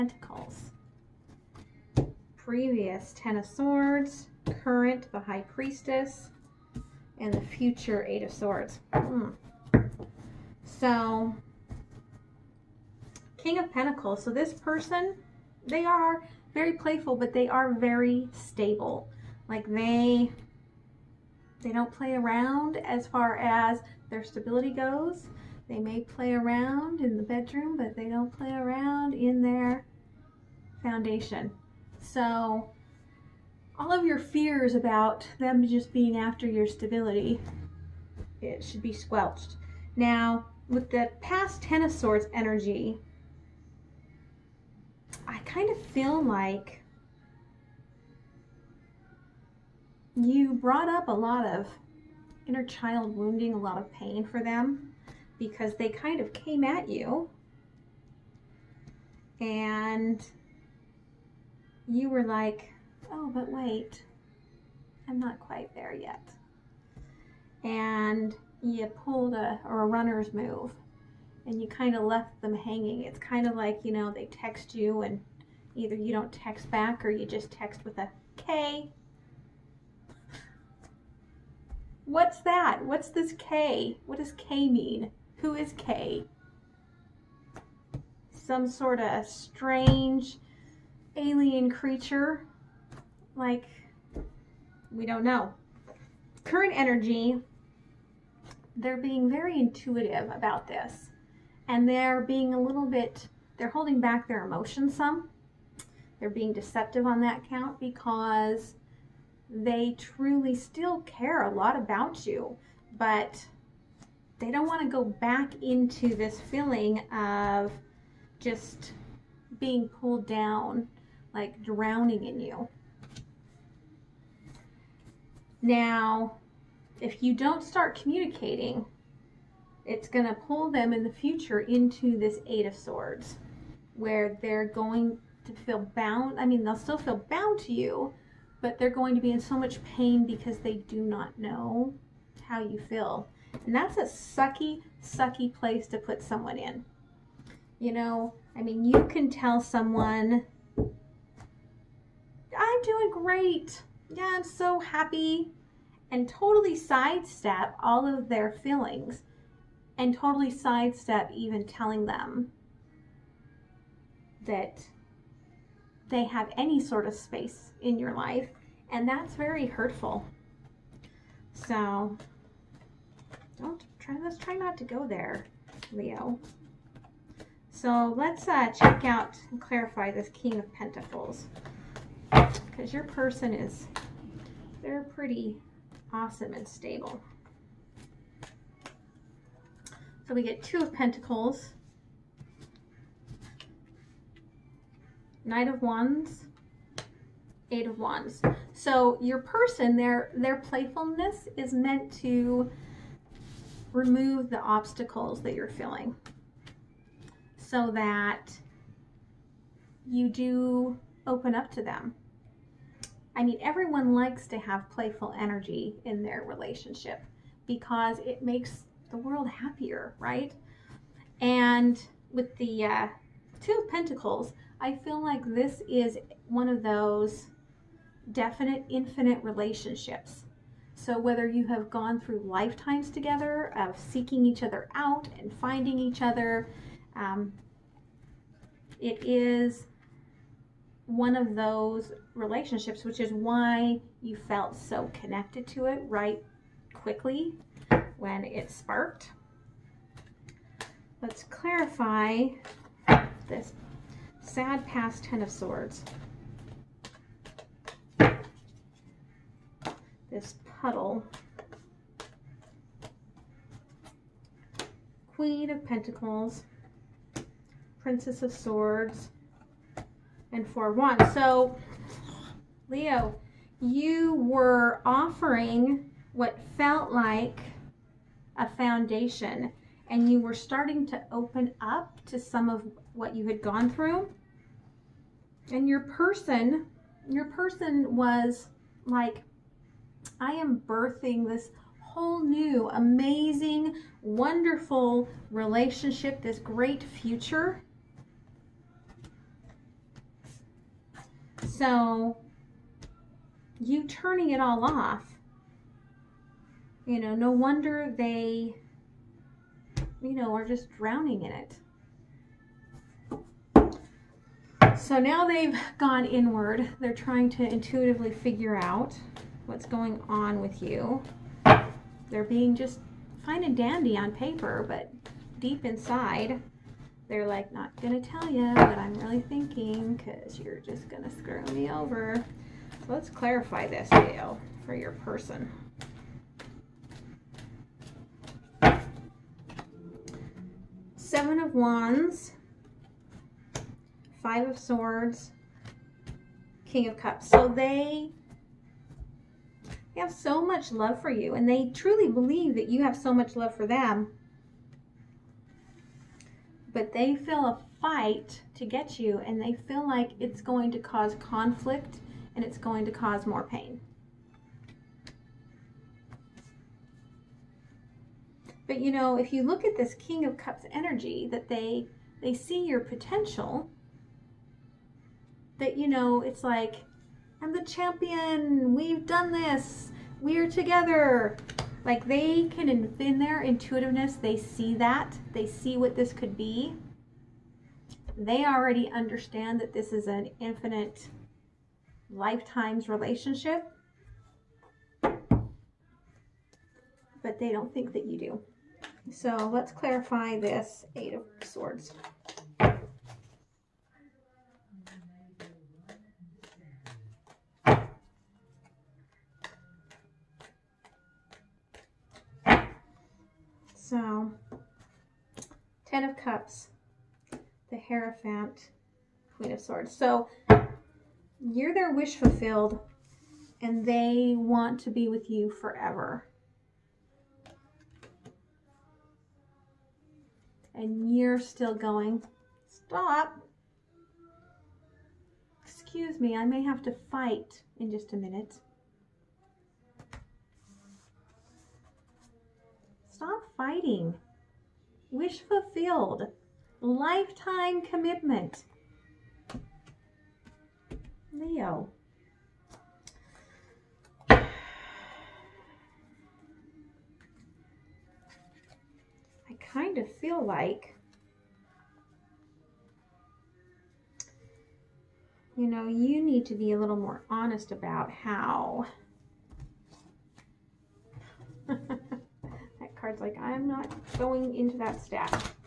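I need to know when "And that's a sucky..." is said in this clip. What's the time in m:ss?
2:23.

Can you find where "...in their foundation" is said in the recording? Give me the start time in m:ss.
0:29.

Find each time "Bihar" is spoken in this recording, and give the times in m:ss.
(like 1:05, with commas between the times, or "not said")
not said.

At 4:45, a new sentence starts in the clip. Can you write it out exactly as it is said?
And your person, your person was like I am birthing this whole new, amazing, wonderful relationship, this great future.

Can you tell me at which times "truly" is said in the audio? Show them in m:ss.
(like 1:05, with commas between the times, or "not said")
1:49, 5:51.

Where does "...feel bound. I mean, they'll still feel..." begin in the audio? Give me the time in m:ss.
2:15.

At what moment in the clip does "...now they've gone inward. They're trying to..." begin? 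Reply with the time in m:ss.
5:15.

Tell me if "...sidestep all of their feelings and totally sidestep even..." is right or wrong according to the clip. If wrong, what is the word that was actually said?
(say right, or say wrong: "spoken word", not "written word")
right.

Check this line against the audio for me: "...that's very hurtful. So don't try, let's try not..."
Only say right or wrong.
right.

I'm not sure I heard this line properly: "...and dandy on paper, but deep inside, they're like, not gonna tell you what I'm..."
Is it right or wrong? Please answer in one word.
right.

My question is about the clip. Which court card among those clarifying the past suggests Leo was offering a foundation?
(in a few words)
Queen of Pentacles.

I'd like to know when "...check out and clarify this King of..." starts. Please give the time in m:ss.
2:58.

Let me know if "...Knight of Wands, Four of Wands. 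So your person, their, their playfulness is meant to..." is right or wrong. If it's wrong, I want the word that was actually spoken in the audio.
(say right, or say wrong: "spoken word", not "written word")
wrong: "Eight", not "Four".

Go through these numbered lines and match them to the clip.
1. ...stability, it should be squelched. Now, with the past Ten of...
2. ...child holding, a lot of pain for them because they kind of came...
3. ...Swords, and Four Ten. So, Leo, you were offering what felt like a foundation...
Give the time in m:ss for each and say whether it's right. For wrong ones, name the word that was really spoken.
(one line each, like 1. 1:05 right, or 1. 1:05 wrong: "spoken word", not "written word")
1. 0:36 right
2. 0:52 wrong: "wounding", not "holding"
3. 4:28 wrong: "Wands", not "Ten".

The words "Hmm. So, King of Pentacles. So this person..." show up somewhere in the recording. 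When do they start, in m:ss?
0:08.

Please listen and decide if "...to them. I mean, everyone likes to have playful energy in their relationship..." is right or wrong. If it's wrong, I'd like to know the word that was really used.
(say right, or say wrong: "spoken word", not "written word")
right.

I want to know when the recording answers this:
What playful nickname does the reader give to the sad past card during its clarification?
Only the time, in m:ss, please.
4:20.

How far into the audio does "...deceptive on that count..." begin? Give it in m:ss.
1:46.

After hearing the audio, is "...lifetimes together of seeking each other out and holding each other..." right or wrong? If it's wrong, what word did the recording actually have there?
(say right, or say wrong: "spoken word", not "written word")
wrong: "finding", not "holding".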